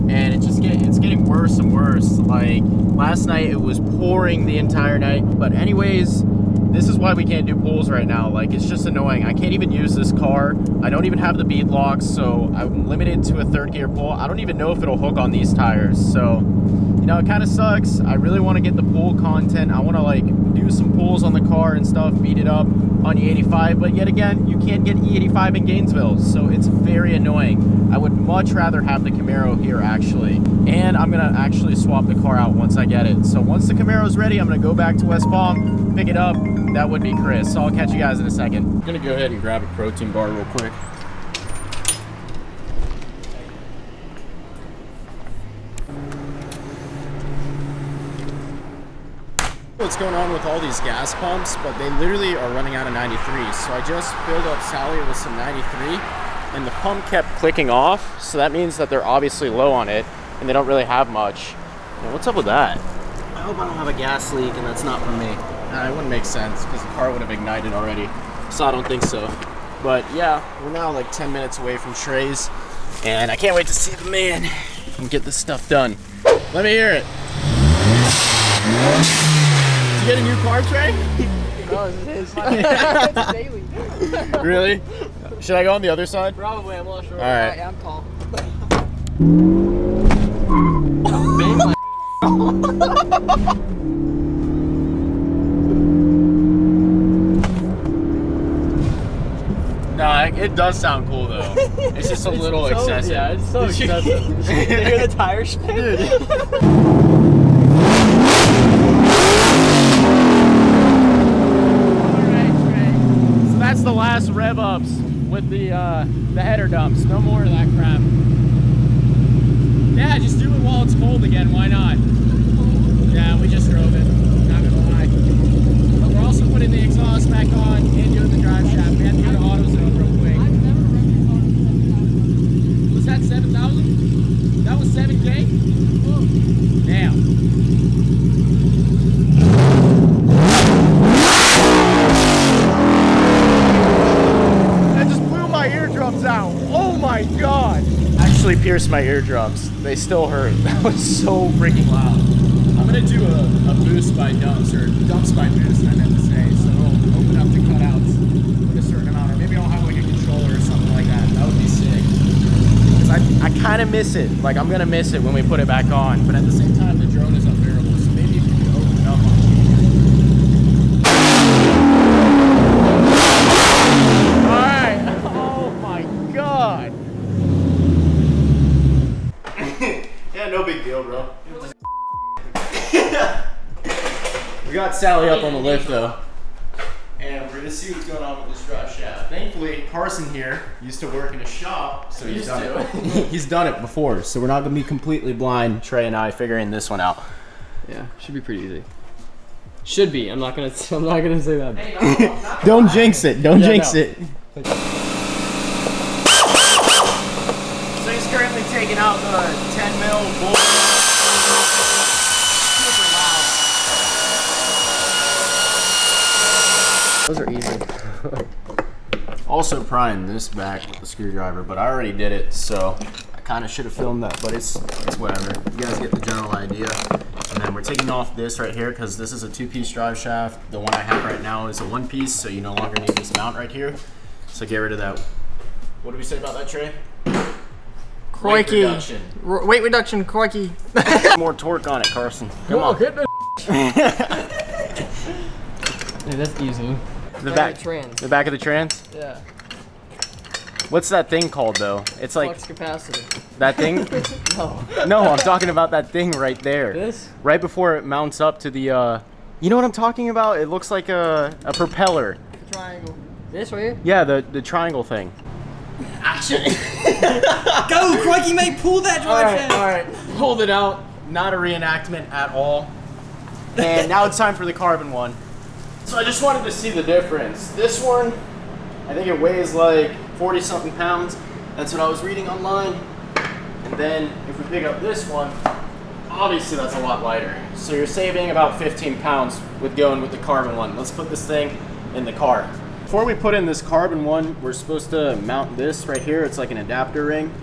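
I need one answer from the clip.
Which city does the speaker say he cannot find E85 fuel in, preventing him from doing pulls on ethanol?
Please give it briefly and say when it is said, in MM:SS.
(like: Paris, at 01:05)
Gainesville, at 00:25.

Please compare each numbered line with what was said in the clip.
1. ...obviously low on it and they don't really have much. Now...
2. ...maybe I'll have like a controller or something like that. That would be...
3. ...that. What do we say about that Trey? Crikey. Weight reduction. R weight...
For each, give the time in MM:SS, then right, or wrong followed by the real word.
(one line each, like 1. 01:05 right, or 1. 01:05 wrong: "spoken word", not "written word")
1. 00:59 right
2. 02:39 right
3. 03:54 right.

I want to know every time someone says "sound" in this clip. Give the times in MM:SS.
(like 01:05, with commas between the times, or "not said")
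01:40.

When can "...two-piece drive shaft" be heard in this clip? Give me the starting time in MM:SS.
03:49.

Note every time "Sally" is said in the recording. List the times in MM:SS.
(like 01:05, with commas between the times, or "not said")
00:54, 03:04.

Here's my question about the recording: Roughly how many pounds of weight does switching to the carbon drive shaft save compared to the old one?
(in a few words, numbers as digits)
15 pounds.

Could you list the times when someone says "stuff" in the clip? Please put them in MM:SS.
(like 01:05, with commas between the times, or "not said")
00:21, 01:15.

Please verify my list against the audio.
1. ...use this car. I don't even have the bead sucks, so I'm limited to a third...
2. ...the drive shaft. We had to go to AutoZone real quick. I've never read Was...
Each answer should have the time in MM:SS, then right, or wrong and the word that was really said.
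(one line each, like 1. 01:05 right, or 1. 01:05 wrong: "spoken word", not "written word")
1. 00:09 wrong: "locks", not "sucks"
2. 02:08 right.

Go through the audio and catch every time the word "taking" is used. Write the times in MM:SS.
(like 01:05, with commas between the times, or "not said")
03:28, 03:47.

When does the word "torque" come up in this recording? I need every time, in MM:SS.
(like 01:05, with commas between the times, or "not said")
04:01.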